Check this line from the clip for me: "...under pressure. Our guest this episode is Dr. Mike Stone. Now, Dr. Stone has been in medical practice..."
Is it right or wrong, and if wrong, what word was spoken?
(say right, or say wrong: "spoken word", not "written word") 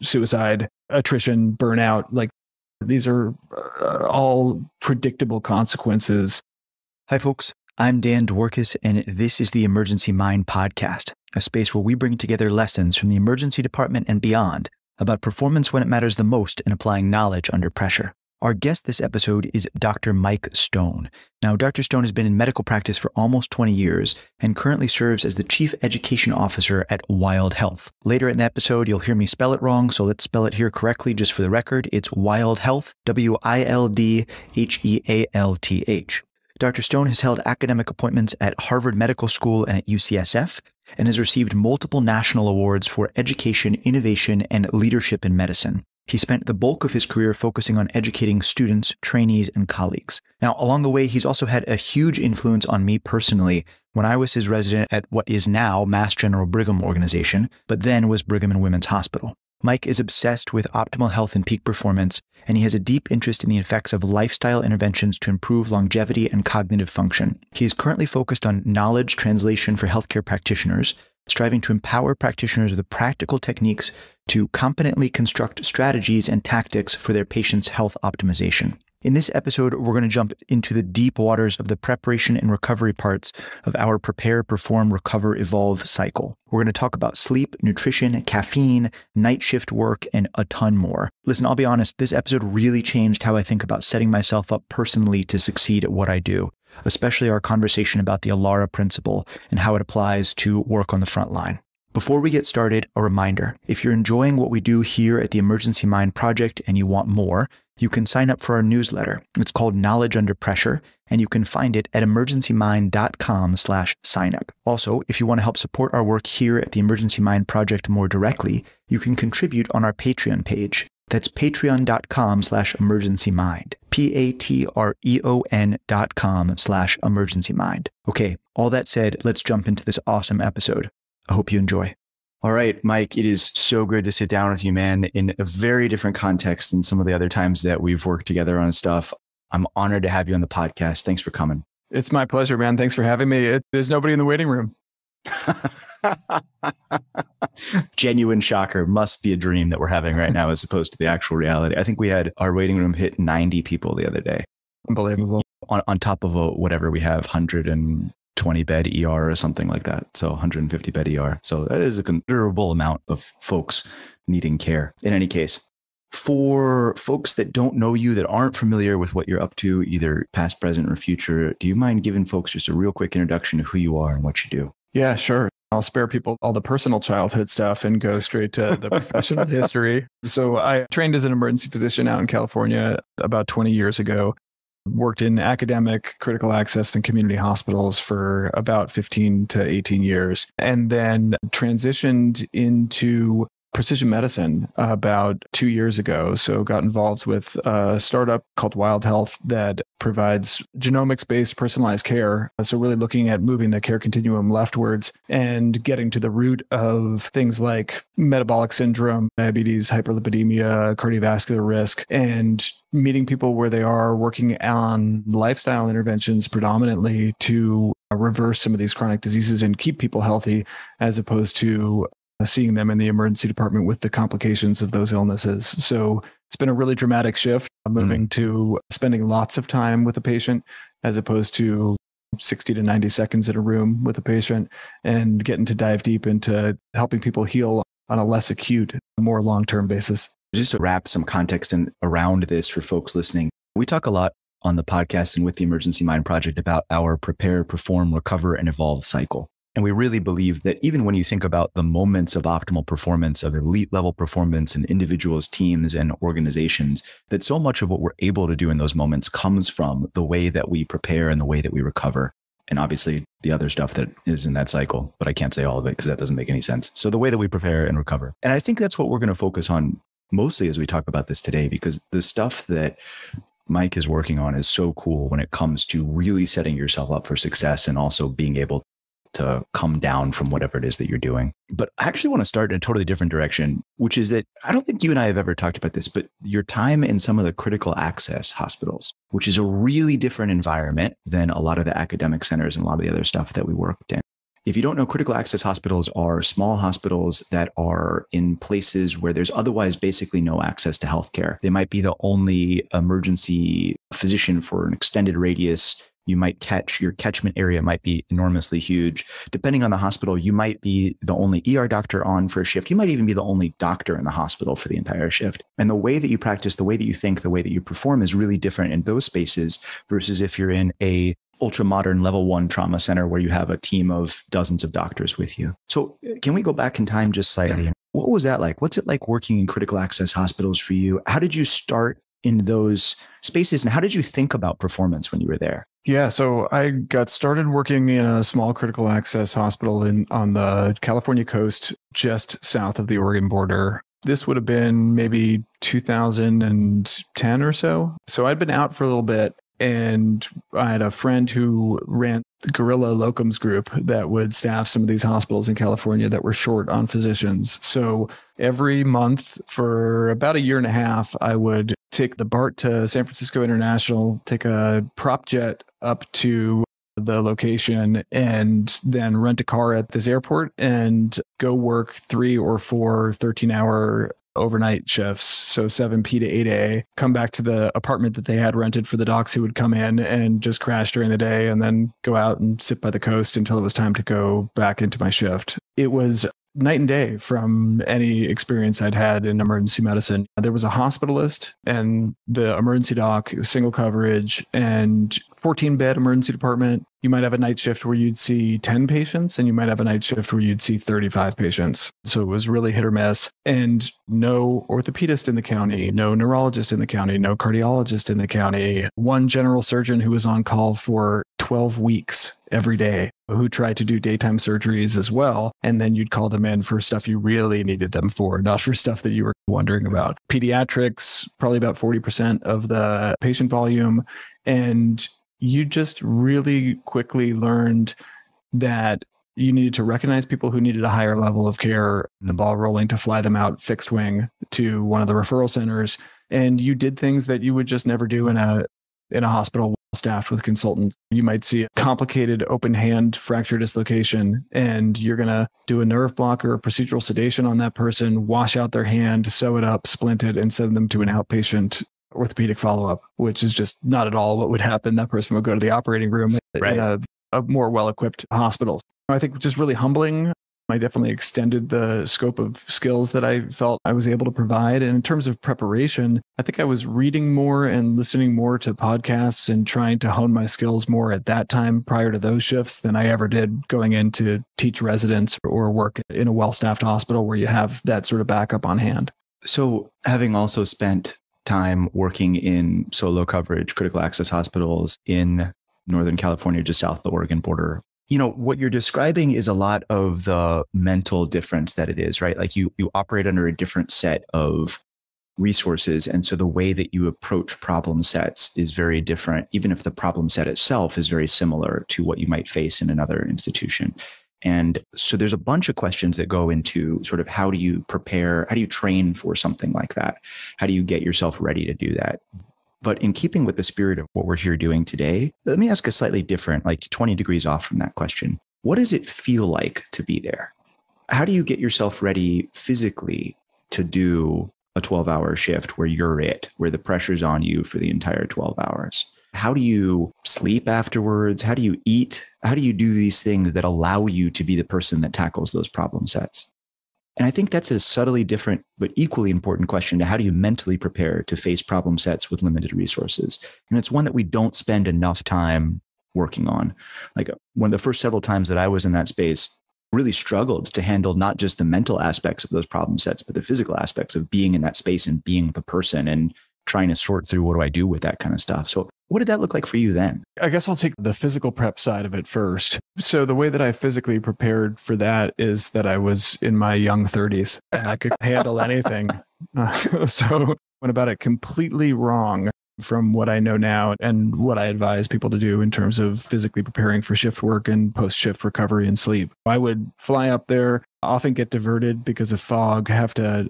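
right.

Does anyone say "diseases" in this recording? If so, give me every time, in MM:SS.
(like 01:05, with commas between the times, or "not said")
03:39.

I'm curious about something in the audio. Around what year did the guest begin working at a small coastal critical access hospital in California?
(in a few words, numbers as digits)
2010.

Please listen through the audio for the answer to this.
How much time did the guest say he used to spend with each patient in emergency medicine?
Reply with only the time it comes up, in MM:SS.
03:52.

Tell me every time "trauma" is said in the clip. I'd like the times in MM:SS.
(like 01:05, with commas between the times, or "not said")
05:22.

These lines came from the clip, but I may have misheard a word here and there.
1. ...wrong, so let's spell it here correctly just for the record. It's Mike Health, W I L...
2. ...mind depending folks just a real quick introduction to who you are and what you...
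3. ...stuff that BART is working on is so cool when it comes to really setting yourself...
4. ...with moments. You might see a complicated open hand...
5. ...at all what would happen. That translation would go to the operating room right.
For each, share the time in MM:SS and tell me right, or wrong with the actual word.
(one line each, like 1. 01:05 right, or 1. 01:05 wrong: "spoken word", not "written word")
1. 00:29 wrong: "Wild", not "Mike"
2. 02:51 wrong: "giving", not "depending"
3. 04:32 wrong: "Mike", not "BART"
4. 07:20 wrong: "consultants", not "moments"
5. 07:34 wrong: "person", not "translation".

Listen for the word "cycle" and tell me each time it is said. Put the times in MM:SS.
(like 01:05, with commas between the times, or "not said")
01:25, 04:09, 04:24.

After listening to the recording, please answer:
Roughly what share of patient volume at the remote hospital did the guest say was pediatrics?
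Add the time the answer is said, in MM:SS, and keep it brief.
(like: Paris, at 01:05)
40%, at 07:01.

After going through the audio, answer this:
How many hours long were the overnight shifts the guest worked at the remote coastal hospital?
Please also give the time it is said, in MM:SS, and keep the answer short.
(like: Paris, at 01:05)
13, at 06:13.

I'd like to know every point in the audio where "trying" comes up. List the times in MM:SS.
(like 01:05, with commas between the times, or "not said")
07:49, 09:16.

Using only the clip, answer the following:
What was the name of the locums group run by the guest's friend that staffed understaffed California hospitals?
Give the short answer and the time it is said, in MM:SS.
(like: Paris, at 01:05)
Gorilla Locums Group, at 05:52.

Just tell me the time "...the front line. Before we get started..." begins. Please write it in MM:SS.
01:40.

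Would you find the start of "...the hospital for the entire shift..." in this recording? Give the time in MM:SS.
05:14.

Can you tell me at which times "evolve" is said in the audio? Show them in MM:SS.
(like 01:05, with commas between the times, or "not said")
01:25, 04:08.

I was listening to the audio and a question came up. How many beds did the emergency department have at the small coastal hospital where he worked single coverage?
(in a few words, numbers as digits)
14.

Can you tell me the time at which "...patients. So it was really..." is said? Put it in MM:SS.
06:41.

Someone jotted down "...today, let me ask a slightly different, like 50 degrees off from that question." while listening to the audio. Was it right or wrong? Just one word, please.
wrong.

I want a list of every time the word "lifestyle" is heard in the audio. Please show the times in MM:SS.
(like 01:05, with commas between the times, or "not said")
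01:04, 03:35.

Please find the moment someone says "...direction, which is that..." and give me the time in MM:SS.
04:43.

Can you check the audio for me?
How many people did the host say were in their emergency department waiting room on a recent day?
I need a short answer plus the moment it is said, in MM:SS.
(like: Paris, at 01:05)
90, at 02:33.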